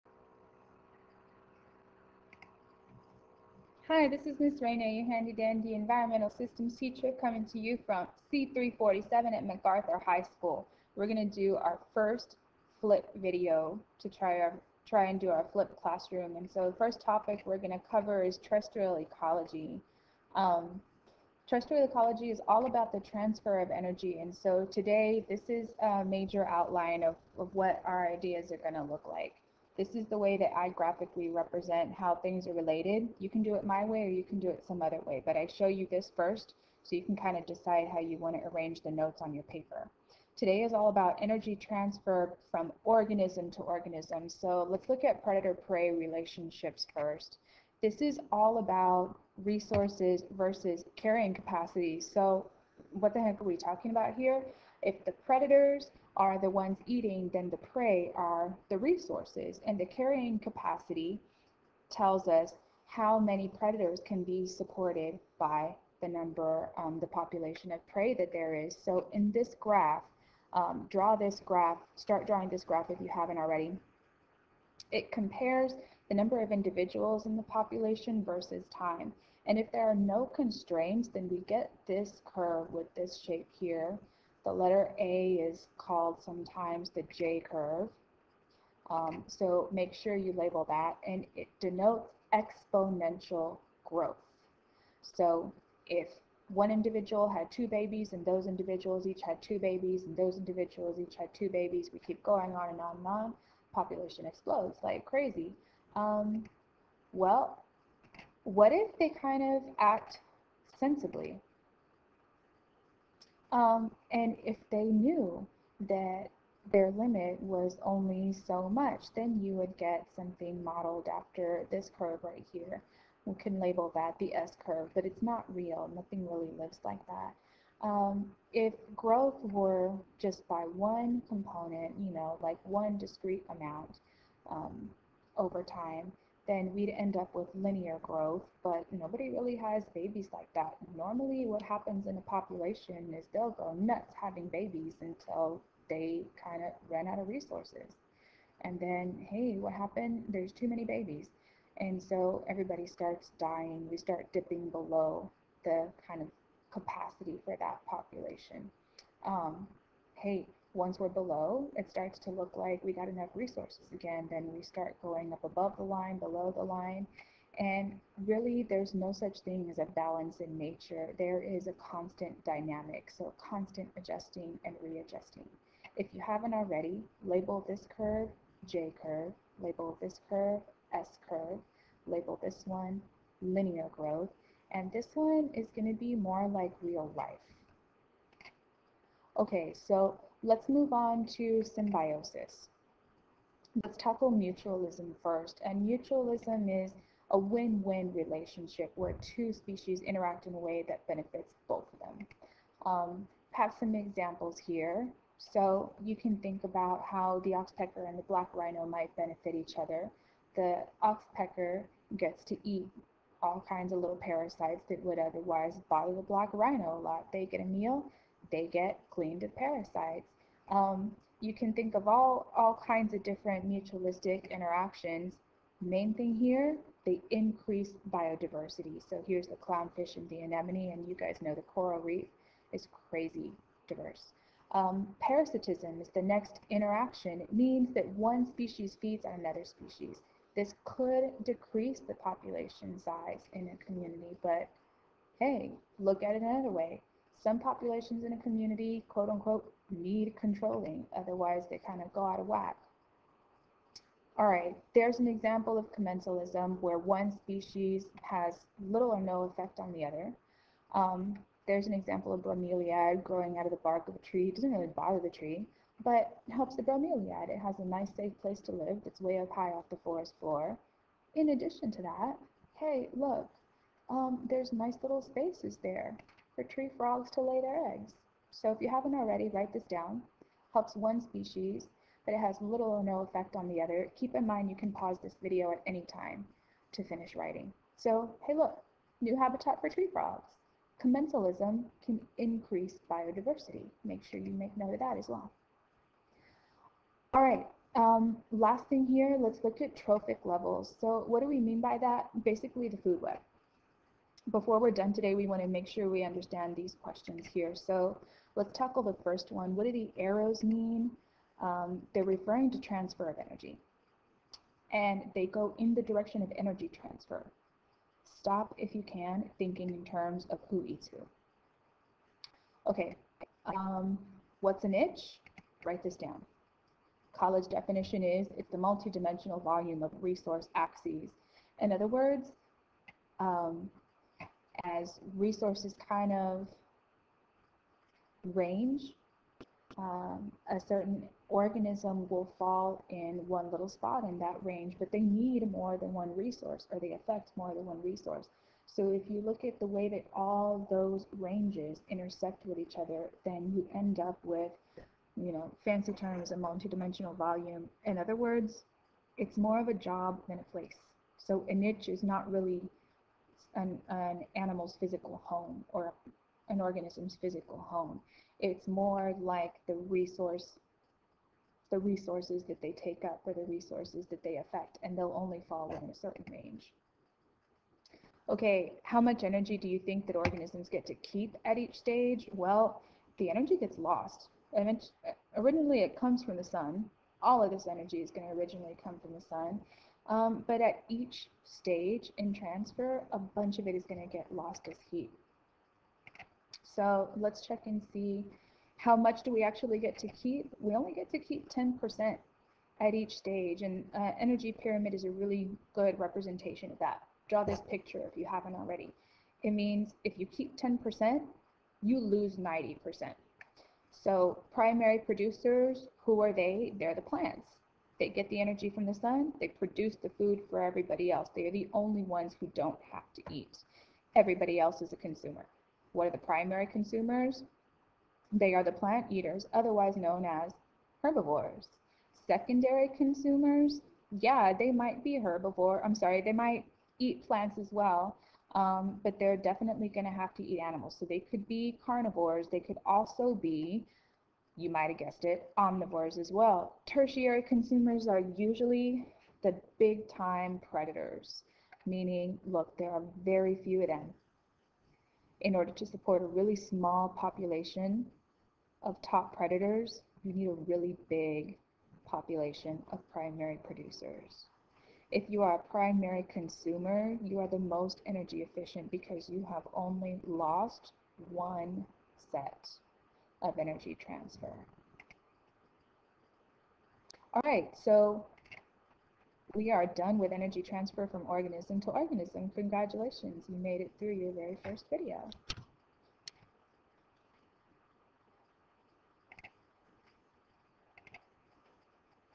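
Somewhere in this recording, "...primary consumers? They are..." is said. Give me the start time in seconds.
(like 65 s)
426 s.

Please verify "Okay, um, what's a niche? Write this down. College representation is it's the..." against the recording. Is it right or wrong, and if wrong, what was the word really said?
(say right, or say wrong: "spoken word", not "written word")
wrong: "definition", not "representation".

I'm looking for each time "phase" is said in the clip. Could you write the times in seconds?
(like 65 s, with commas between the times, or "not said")
not said.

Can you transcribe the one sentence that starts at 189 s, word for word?
Okay, so Let's move on to symbiosis.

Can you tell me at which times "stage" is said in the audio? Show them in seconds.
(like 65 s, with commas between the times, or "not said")
381 s, 391 s, 403 s.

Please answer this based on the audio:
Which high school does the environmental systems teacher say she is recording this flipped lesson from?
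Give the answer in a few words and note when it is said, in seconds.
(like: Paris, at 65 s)
MacArthur High School, at 9 s.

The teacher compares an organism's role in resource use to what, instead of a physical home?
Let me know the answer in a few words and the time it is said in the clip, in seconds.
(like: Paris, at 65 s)
a job, at 359 s.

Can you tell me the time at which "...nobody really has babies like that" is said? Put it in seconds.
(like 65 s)
138 s.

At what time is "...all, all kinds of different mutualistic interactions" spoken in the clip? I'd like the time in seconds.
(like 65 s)
222 s.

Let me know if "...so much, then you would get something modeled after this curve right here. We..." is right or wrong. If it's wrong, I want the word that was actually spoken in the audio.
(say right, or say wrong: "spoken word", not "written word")
right.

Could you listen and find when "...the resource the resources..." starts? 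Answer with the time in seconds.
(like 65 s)
369 s.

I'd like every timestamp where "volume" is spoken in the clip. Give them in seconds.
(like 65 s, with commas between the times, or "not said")
329 s, 357 s.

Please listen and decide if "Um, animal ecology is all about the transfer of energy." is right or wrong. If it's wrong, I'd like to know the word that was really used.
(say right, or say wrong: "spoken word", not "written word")
wrong: "terrestrial", not "animal".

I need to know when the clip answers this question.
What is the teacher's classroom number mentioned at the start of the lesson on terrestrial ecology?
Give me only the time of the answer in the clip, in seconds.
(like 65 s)
8 s.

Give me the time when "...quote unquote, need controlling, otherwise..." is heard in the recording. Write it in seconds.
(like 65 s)
249 s.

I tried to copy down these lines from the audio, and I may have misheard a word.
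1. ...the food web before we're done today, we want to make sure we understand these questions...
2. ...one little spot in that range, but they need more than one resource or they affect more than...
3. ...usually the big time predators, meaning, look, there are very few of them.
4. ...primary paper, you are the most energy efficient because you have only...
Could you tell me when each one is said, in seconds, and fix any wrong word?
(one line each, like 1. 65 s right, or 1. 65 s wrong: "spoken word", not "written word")
1. 302 s right
2. 343 s right
3. 448 s right
4. 465 s wrong: "consumer", not "paper".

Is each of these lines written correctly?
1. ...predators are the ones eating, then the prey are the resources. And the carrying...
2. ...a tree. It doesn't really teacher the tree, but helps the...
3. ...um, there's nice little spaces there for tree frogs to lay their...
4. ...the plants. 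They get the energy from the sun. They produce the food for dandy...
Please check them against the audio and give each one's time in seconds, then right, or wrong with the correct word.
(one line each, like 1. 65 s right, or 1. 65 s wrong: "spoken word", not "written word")
1. 55 s right
2. 264 s wrong: "bother", not "teacher"
3. 274 s right
4. 417 s wrong: "everybody", not "dandy".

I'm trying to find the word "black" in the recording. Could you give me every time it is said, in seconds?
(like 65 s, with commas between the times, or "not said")
208 s, 216 s.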